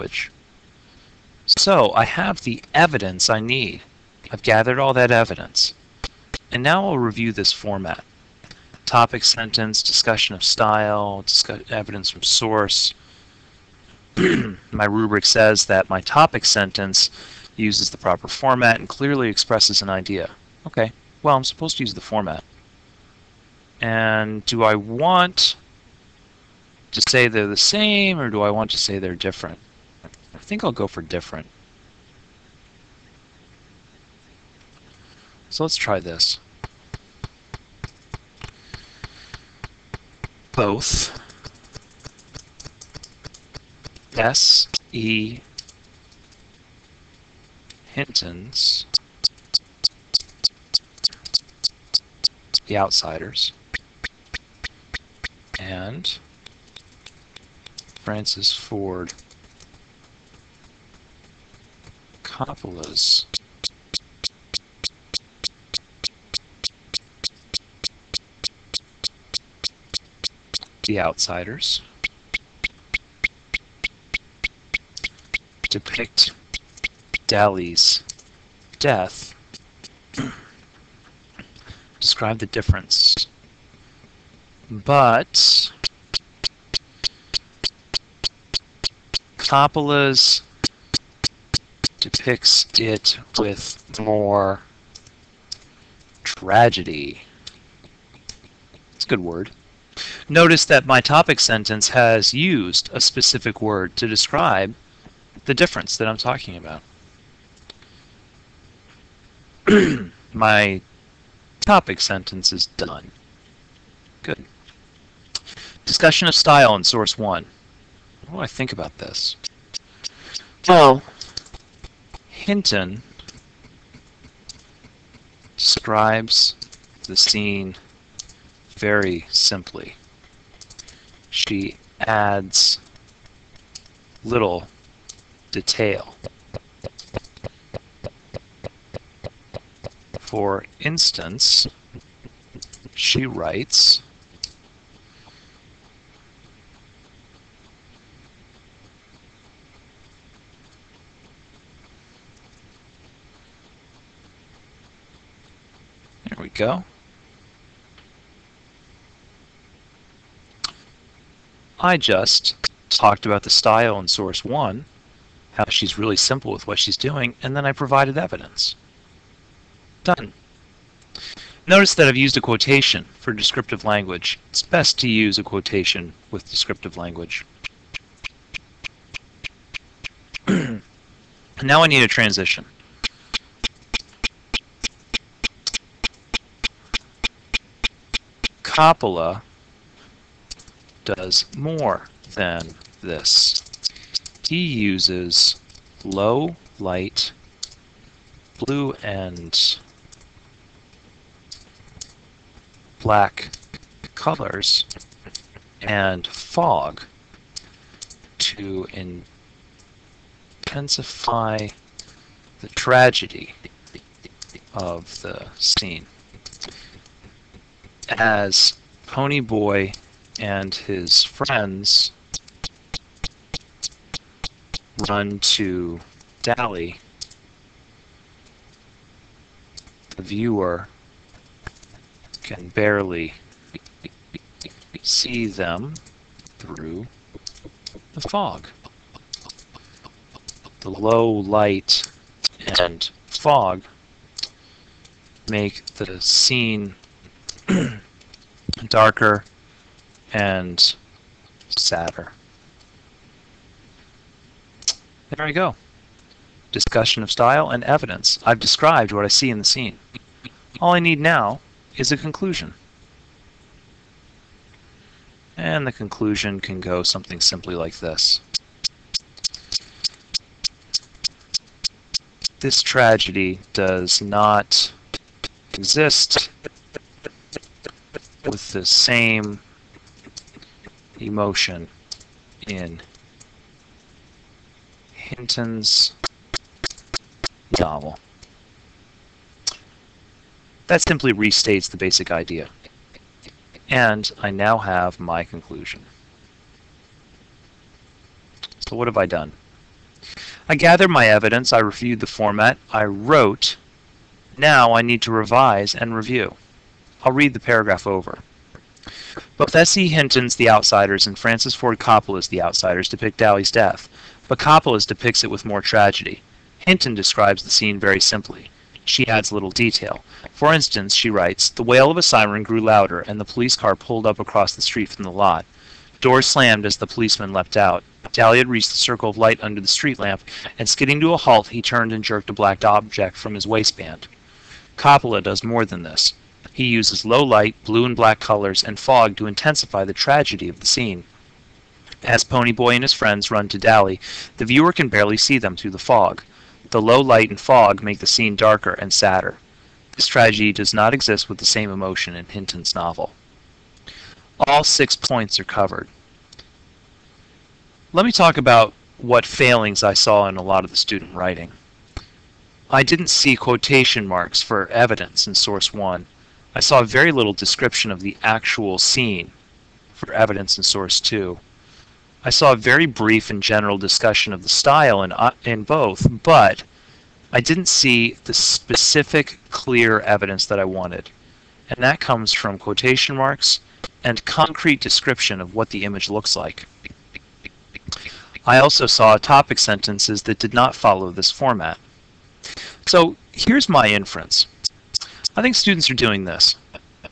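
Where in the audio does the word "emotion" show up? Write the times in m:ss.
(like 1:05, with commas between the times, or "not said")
4:41, 5:51.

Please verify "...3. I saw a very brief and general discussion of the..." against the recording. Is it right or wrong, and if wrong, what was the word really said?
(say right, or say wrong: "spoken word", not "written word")
wrong: "2", not "3".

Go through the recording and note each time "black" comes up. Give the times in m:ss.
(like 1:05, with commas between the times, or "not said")
3:22, 5:32, 5:38.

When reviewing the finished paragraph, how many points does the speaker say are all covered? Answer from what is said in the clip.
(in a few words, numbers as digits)
6.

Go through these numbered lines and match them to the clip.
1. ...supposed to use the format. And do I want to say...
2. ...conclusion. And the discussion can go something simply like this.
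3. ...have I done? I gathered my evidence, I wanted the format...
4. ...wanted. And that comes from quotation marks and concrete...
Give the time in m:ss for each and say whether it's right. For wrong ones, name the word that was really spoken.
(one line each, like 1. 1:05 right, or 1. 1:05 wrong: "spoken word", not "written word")
1. 0:21 right
2. 4:22 wrong: "conclusion", not "discussion"
3. 4:59 wrong: "reviewed", not "wanted"
4. 6:20 right.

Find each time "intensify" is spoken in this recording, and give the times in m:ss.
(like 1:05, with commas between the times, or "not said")
3:30, 5:39.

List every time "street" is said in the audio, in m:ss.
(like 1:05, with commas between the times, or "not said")
5:24, 5:29.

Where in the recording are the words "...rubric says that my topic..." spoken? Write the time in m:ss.
0:14.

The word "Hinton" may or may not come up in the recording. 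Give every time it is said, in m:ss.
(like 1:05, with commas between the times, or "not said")
0:47, 2:02, 4:45, 5:10, 5:16, 5:52.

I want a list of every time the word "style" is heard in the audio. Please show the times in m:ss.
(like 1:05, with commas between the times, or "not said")
0:10, 1:56, 2:43, 4:17, 6:14.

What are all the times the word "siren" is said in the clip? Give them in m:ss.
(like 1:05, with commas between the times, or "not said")
5:22.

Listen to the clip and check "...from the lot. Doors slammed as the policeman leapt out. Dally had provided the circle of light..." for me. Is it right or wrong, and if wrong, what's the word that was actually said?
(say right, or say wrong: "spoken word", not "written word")
wrong: "reached", not "provided".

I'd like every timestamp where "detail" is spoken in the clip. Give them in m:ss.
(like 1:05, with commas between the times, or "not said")
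2:15, 5:19.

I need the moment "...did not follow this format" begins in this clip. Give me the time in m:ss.
6:30.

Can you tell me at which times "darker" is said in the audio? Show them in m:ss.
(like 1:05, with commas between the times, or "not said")
4:08, 5:48.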